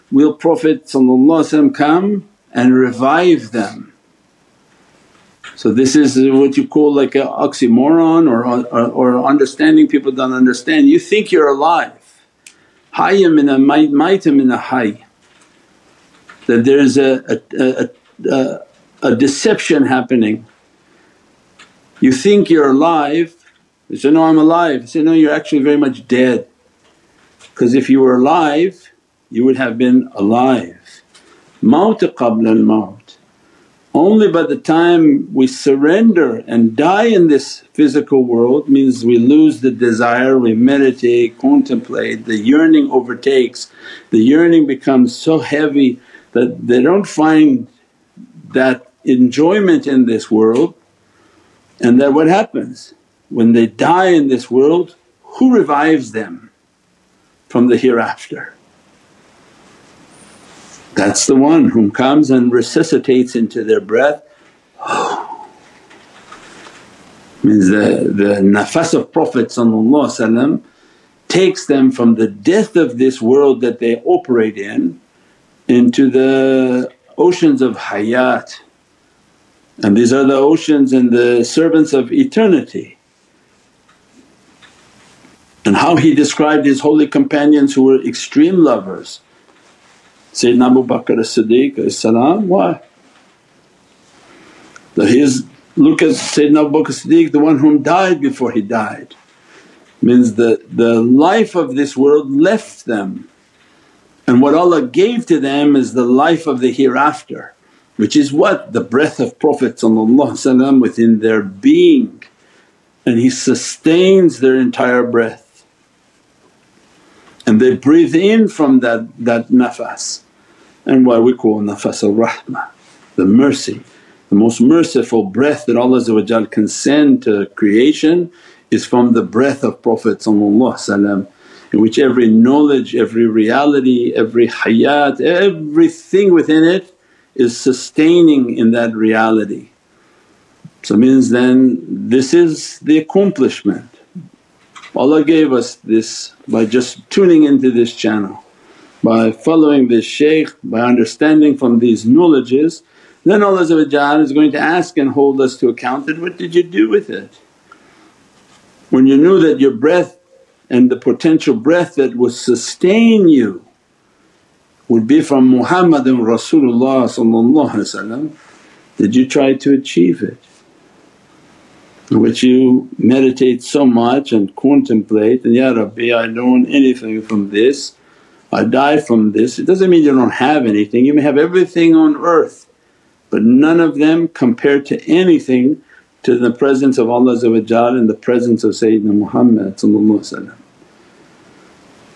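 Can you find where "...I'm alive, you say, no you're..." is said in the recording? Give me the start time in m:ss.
0:24.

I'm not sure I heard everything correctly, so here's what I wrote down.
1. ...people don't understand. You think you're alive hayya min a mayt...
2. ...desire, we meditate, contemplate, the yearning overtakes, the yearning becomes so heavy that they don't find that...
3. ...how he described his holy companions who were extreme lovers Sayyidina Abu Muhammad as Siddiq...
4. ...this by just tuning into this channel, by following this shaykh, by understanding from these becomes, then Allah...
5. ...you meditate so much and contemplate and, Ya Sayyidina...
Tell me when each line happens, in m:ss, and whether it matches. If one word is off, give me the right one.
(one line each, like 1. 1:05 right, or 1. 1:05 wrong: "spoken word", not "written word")
1. 0:09 right
2. 0:39 right
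3. 1:25 wrong: "Bakr", not "Muhammad"
4. 2:25 wrong: "knowledges", not "becomes"
5. 2:52 wrong: "Rabbi", not "Sayyidina".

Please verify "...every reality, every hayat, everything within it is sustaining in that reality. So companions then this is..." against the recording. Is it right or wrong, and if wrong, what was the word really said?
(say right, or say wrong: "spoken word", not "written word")
wrong: "means", not "companions".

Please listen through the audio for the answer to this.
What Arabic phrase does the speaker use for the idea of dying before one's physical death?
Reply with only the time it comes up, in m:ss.
0:31.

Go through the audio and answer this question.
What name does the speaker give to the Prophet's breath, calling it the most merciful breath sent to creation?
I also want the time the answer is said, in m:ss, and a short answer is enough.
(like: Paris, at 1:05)
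nafas al-rahmah, at 2:01.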